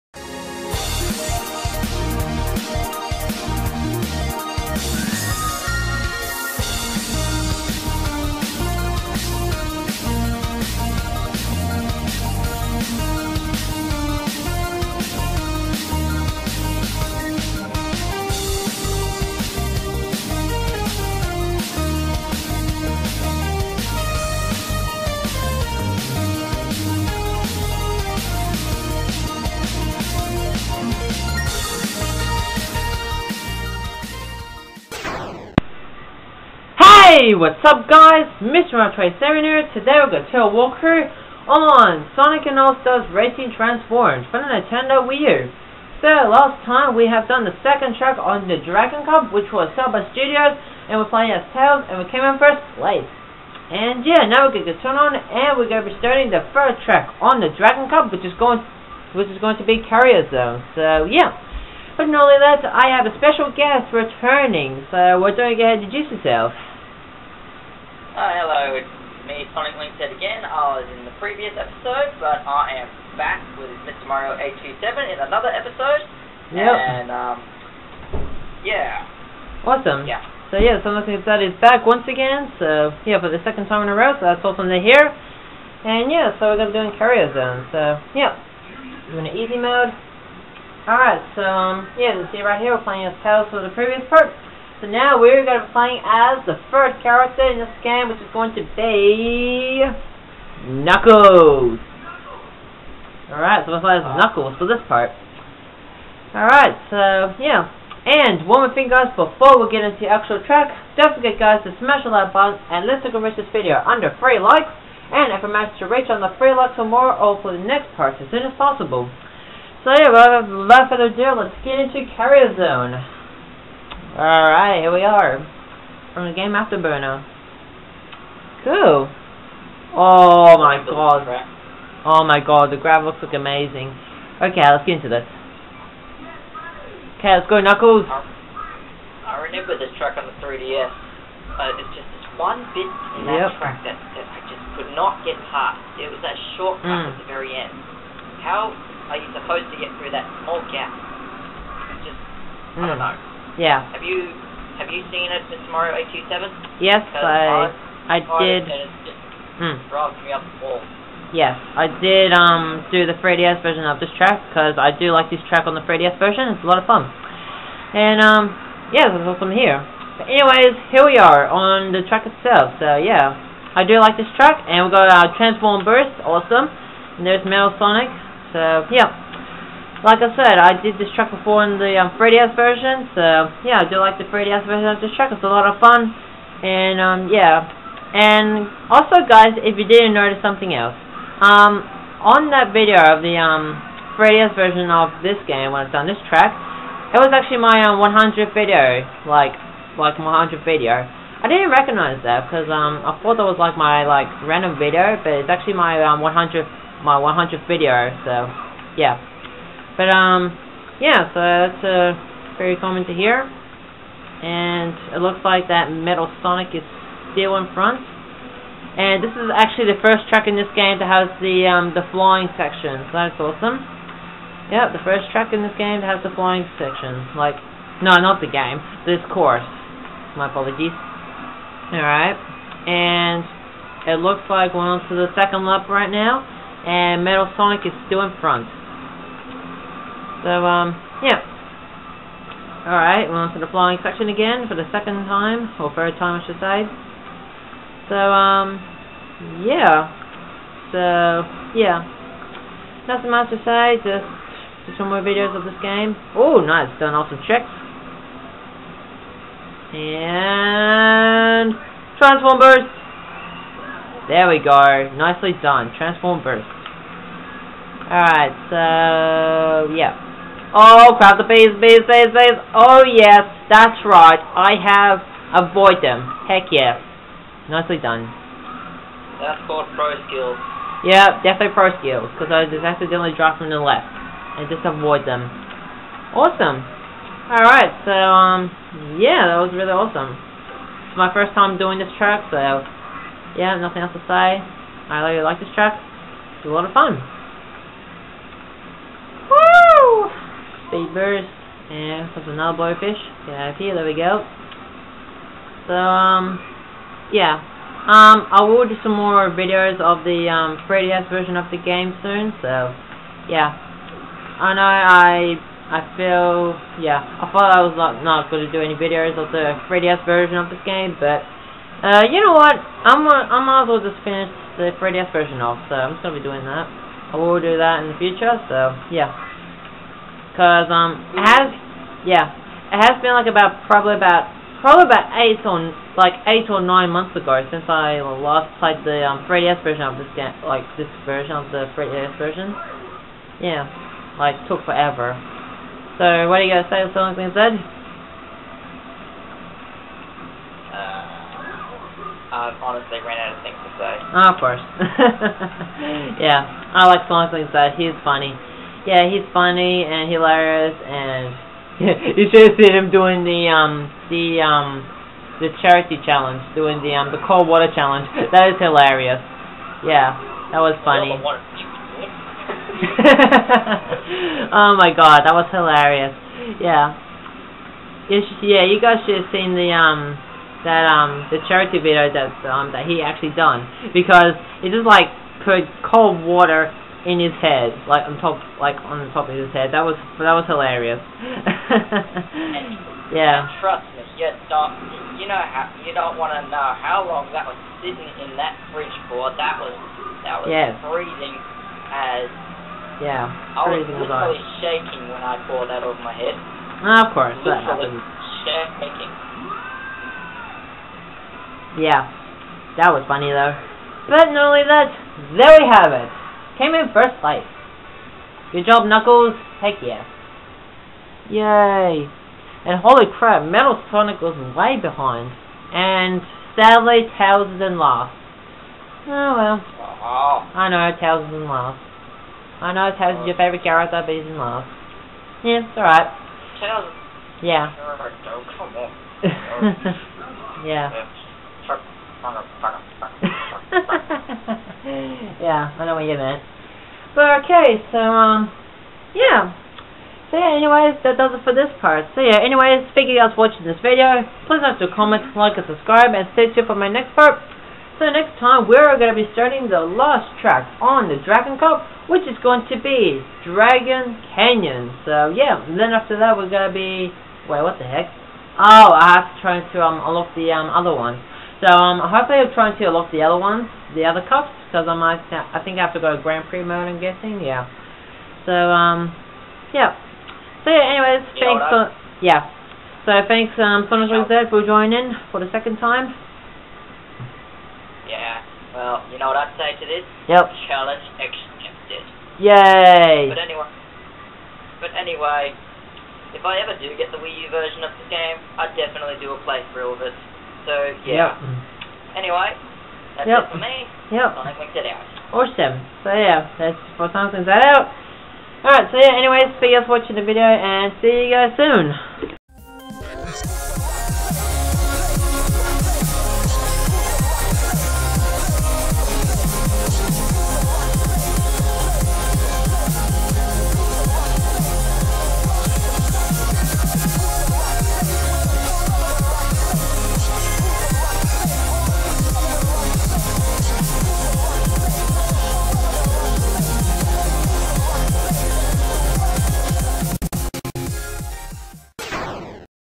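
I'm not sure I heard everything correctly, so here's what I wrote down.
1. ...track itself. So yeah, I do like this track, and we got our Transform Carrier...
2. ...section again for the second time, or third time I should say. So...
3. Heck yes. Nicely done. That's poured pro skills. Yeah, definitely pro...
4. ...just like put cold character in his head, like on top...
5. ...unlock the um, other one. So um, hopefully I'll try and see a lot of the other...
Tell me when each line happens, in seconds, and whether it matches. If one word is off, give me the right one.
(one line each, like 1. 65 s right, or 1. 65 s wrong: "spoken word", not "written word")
1. 172 s wrong: "Burst", not "Carrier"
2. 244 s right
3. 276 s wrong: "called", not "poured"
4. 384 s wrong: "water", not "character"
5. 470 s right.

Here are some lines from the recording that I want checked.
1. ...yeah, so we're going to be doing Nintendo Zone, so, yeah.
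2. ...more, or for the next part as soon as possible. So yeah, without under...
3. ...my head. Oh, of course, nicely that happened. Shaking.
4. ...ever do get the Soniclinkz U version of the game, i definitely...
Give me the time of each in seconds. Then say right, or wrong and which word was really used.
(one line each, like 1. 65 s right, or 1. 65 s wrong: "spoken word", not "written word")
1. 86 s wrong: "Carrier", not "Nintendo"
2. 116 s wrong: "further", not "under"
3. 406 s wrong: "literally", not "nicely"
4. 496 s wrong: "Wii", not "Soniclinkz".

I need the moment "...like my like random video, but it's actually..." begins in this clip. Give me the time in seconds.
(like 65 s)
203 s.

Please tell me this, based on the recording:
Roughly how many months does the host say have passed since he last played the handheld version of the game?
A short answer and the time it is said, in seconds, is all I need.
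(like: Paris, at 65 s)
8 or 9 months, at 336 s.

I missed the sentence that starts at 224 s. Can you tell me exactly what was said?
Yep, the first track in this game that has the flying section.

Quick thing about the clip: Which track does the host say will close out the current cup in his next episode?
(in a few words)
Dragon Canyon.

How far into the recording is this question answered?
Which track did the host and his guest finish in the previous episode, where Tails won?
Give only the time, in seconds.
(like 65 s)
49 s.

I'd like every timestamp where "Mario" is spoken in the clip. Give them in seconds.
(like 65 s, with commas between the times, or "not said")
74 s, 155 s.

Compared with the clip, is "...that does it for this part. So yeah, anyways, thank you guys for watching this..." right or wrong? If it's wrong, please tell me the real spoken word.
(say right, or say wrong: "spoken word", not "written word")
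right.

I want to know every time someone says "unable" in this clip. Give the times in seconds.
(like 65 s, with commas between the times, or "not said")
not said.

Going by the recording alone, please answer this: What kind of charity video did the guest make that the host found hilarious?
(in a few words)
cold water challenge.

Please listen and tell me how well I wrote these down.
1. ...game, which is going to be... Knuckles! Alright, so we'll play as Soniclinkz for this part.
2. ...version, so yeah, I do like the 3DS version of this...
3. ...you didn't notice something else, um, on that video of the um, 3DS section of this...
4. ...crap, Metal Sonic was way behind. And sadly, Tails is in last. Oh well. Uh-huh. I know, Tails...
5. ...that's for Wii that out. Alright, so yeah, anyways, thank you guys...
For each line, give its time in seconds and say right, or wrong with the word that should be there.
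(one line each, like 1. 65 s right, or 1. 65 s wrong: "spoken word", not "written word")
1. 97 s wrong: "Knuckles", not "Soniclinkz"
2. 182 s right
3. 189 s wrong: "version", not "section"
4. 423 s right
5. 506 s wrong: "Sonic", not "Wii".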